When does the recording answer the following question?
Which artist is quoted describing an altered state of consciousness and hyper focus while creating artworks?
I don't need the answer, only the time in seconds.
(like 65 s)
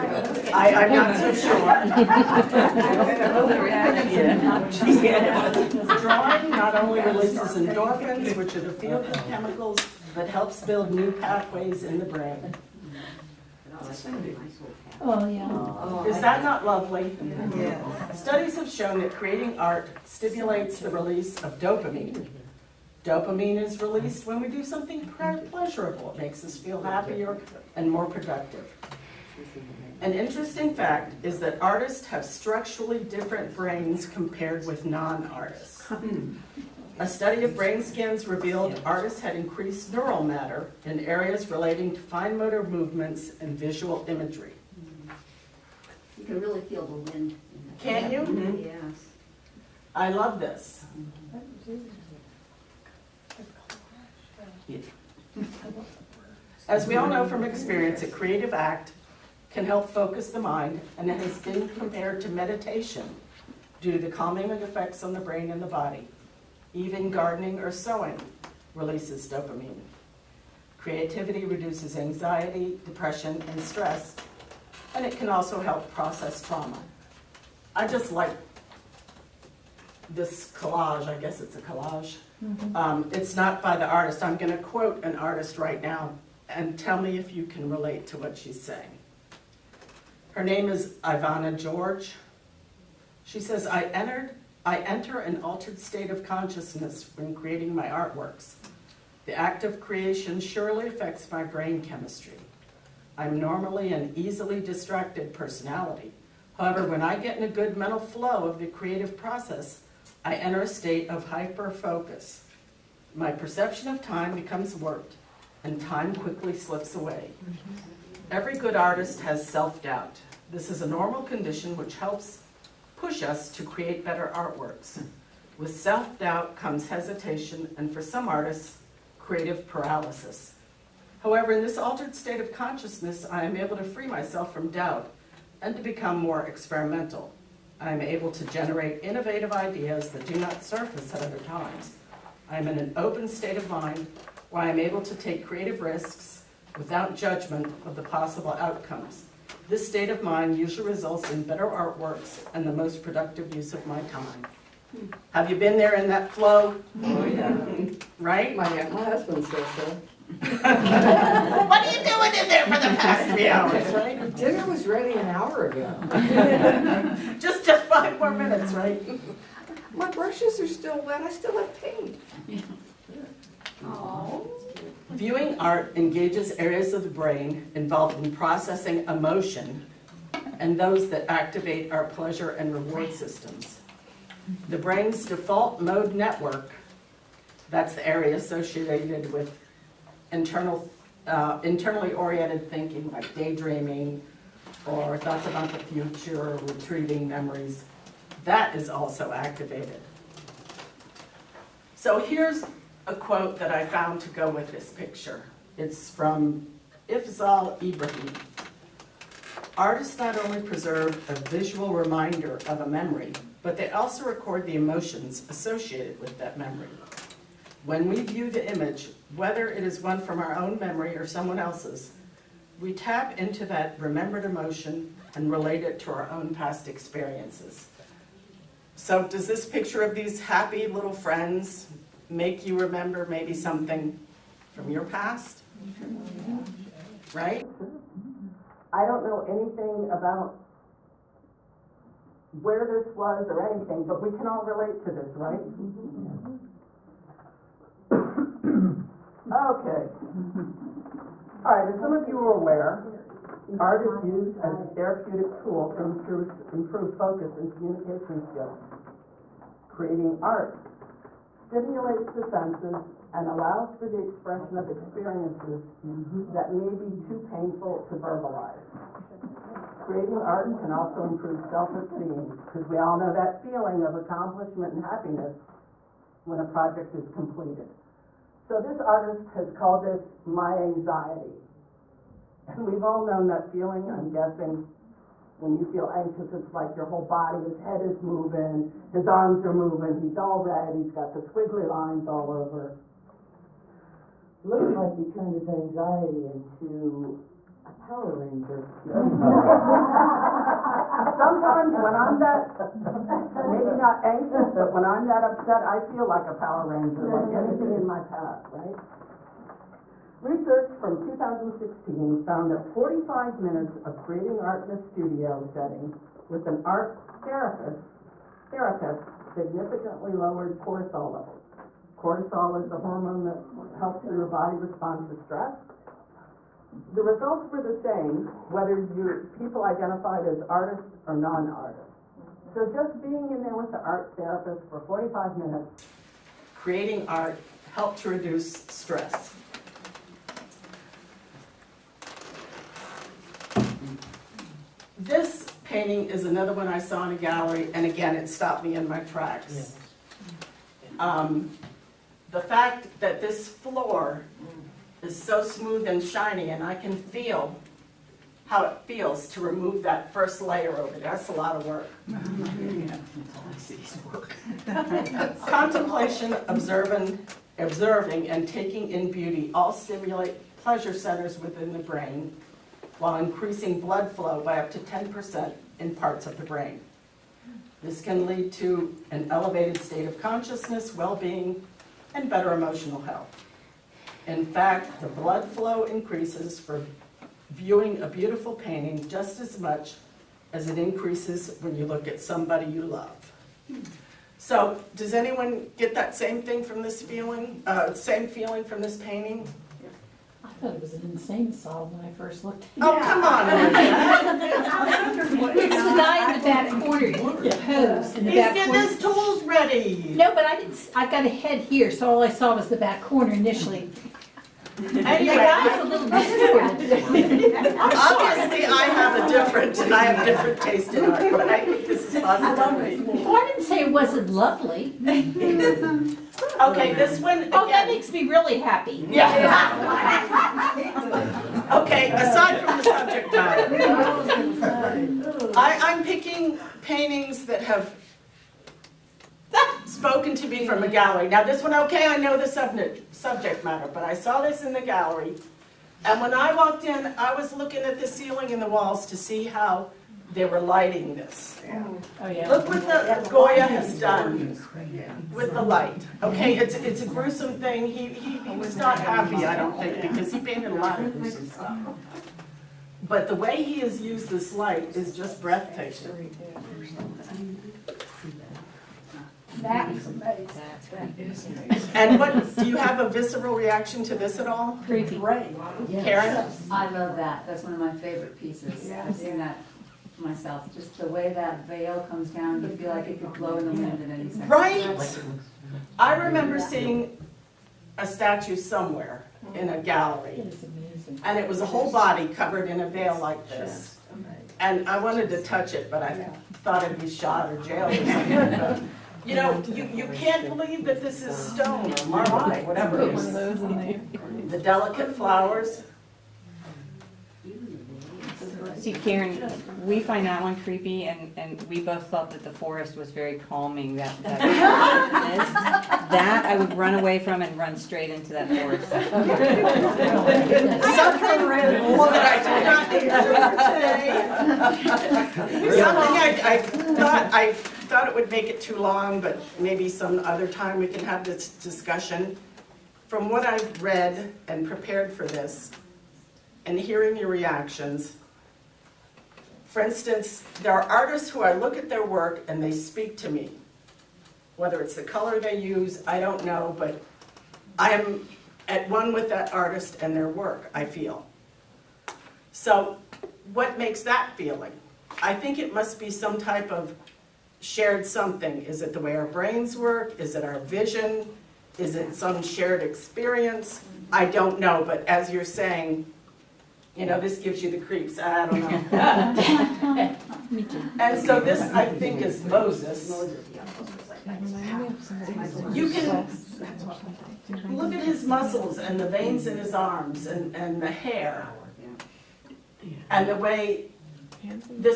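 91 s.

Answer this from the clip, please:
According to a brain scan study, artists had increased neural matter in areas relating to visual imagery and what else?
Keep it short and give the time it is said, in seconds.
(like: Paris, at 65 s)
Fine motor movements, at 41 s.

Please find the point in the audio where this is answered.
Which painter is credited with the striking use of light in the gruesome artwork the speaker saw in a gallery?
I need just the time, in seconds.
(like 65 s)
453 s.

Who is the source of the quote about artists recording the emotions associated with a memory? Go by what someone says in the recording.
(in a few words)
Ifzal Ibrahim.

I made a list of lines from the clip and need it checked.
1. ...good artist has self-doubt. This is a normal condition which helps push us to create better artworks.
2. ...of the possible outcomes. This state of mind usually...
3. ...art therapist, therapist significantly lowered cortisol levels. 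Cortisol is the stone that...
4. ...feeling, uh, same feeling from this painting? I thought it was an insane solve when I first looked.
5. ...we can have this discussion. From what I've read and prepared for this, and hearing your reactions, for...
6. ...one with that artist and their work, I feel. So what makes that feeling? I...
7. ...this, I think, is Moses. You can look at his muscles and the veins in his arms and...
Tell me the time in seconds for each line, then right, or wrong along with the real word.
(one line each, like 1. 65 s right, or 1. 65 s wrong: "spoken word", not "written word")
1. 118 s right
2. 147 s right
3. 316 s wrong: "hormone", not "stone"
4. 397 s right
5. 530 s right
6. 549 s right
7. 571 s right.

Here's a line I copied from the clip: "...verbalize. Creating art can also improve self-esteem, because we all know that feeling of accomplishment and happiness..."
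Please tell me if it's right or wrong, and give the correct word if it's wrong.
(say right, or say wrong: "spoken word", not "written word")
right.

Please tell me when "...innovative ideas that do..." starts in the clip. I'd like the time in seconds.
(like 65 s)
139 s.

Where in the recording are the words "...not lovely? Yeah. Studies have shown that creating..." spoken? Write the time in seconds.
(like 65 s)
16 s.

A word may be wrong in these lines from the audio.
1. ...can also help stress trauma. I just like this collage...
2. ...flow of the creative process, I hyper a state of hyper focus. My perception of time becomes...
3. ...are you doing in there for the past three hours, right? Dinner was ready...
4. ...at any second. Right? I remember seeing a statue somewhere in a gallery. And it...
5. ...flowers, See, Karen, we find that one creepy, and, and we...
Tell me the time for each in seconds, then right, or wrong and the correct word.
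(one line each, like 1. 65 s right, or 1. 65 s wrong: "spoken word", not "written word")
1. 75 s wrong: "process", not "stress"
2. 107 s wrong: "enter", not "hyper"
3. 160 s right
4. 484 s right
5. 505 s right.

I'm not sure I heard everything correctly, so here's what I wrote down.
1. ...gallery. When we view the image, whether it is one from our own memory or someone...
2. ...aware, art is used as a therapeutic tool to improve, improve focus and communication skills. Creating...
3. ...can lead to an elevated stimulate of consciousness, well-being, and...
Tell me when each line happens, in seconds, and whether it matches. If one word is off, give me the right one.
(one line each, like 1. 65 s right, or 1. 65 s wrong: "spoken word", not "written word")
1. 216 s wrong: "memory", not "gallery"
2. 252 s right
3. 378 s wrong: "state", not "stimulate".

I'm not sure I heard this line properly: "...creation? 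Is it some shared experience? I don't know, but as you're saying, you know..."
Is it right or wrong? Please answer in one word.
wrong.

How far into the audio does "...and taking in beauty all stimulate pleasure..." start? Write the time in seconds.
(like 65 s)
368 s.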